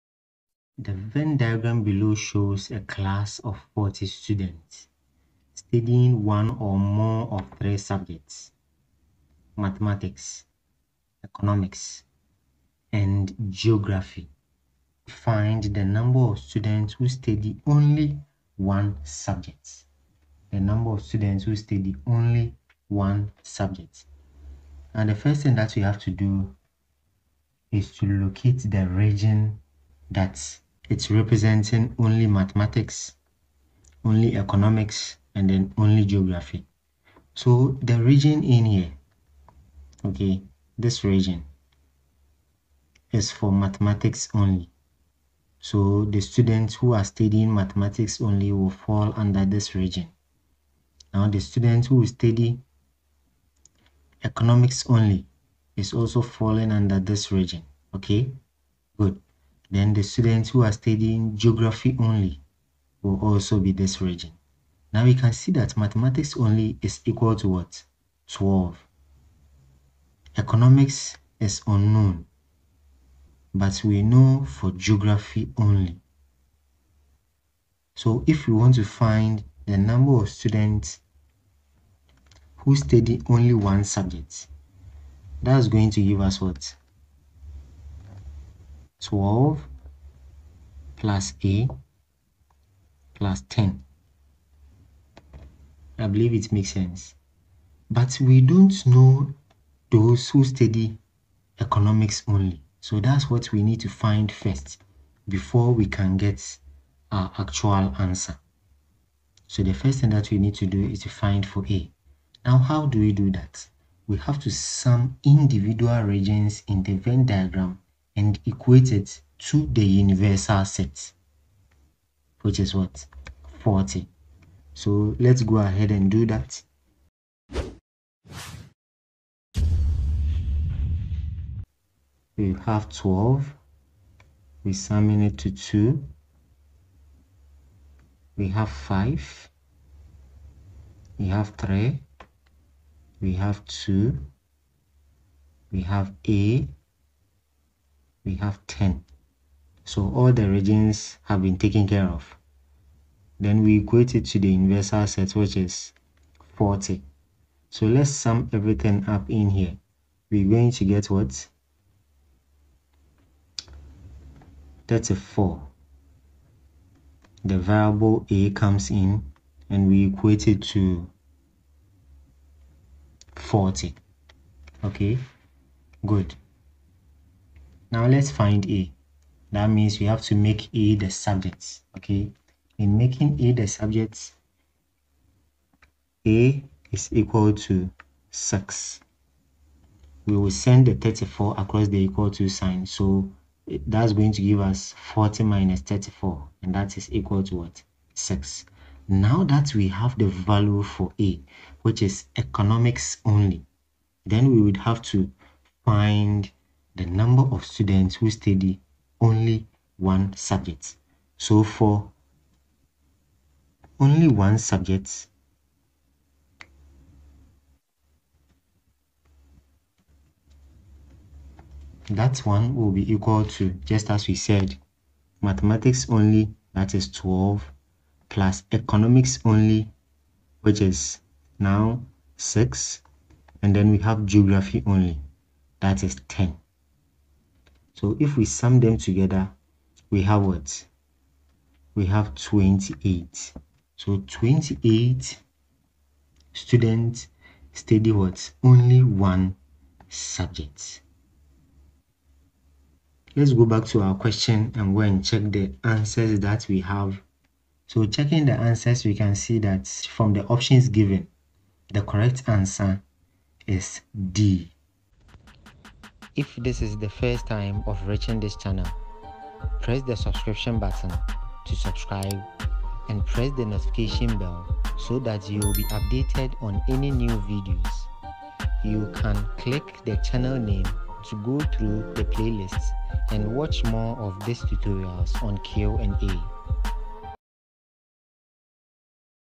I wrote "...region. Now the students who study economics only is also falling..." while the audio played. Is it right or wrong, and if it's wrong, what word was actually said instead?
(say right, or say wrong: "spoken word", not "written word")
right.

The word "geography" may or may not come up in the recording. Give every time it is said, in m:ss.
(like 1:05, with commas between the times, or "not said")
0:13, 0:36, 1:01, 1:14, 3:54.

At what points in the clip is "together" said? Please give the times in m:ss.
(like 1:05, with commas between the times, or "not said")
3:58.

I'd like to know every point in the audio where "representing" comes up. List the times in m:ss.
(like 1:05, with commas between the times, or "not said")
0:31.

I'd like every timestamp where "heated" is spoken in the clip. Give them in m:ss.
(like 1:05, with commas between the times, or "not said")
not said.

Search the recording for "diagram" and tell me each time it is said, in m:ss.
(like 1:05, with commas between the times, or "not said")
0:01, 1:57.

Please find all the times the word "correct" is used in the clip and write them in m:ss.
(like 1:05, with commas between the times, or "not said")
4:22.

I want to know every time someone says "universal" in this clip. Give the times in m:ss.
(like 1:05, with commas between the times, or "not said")
1:59, 2:34.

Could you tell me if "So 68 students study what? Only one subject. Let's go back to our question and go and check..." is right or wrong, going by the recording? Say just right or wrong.
wrong.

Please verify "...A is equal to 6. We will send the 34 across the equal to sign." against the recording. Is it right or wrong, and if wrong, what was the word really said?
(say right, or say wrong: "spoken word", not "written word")
right.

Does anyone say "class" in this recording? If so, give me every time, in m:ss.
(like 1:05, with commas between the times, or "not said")
0:02.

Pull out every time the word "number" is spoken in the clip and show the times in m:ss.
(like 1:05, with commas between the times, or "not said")
0:15, 0:20, 1:19, 3:27.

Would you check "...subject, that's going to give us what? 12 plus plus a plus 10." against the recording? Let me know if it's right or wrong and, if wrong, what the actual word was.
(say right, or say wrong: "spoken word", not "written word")
right.